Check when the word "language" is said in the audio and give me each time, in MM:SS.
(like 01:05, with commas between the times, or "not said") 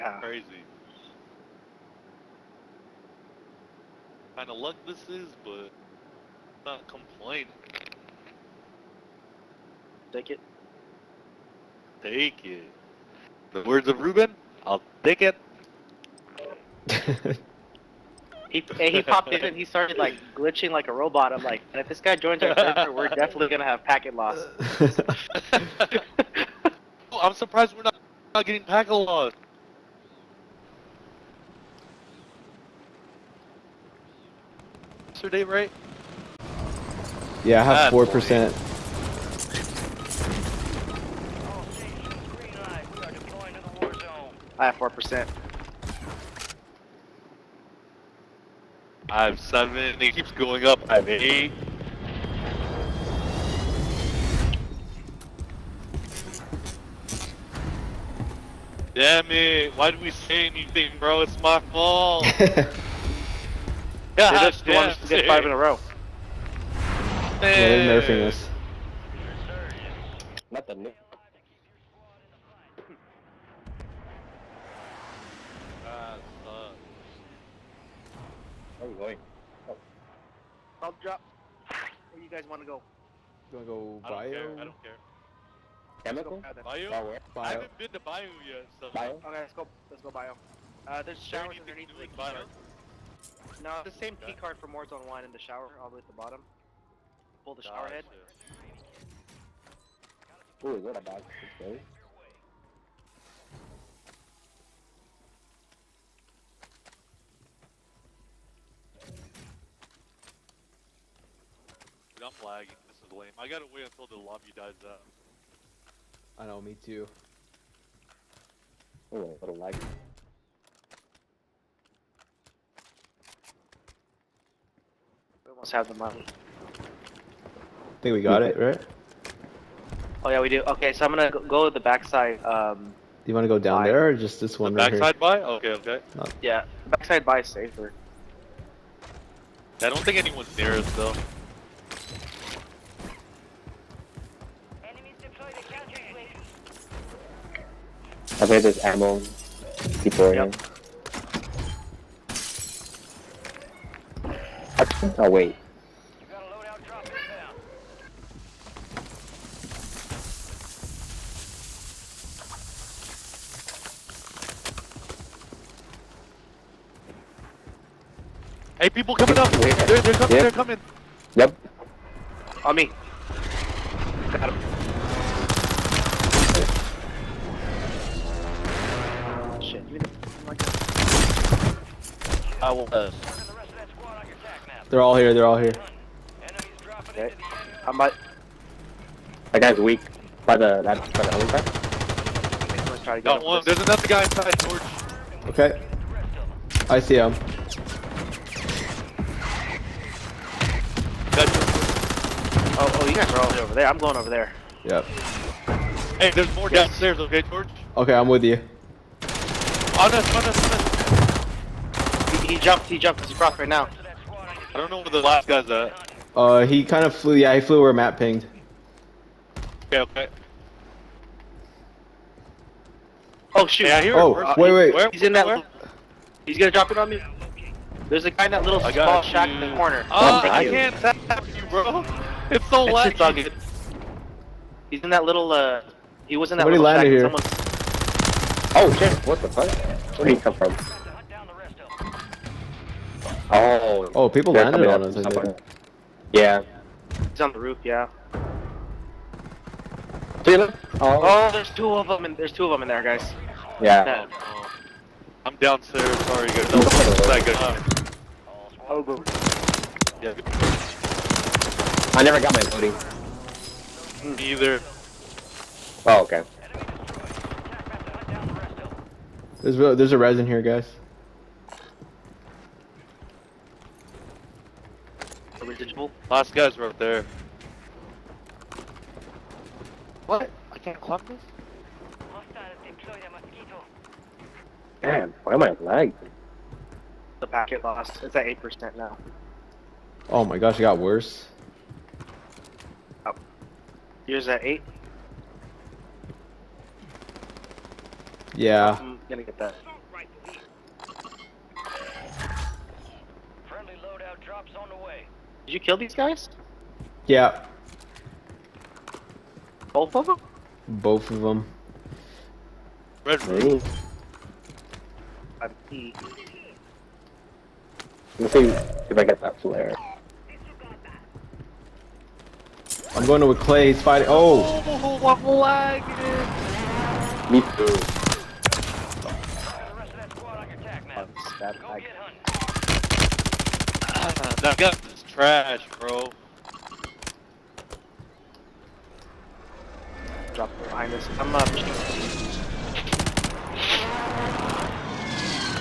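not said.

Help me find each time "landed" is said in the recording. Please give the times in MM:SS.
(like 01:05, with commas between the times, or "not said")
03:57, 04:04.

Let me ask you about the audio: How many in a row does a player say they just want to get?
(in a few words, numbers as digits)
5.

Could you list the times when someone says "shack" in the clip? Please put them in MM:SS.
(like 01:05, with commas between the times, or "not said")
03:49, 03:57.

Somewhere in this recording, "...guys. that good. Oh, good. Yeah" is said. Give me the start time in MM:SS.
04:16.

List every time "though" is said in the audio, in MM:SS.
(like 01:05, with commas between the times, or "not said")
02:20.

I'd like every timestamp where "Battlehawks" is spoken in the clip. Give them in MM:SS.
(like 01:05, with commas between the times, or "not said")
not said.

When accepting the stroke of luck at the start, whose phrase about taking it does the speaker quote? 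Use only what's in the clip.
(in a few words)
Ruben.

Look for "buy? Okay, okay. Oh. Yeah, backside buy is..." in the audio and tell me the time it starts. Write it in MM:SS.
02:15.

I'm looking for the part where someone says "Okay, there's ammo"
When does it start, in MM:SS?
02:28.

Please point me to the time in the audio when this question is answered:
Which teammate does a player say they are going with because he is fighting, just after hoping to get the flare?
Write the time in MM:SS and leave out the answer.
05:23.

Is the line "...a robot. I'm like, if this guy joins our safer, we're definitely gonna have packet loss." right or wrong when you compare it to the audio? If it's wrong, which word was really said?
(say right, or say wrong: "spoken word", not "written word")
wrong: "server", not "safer".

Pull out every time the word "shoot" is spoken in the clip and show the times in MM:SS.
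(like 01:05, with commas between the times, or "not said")
03:43.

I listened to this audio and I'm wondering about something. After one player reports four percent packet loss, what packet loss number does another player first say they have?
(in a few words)
7.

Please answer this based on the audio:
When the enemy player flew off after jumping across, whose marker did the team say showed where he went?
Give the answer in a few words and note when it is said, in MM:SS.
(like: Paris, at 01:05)
Matt, at 03:37.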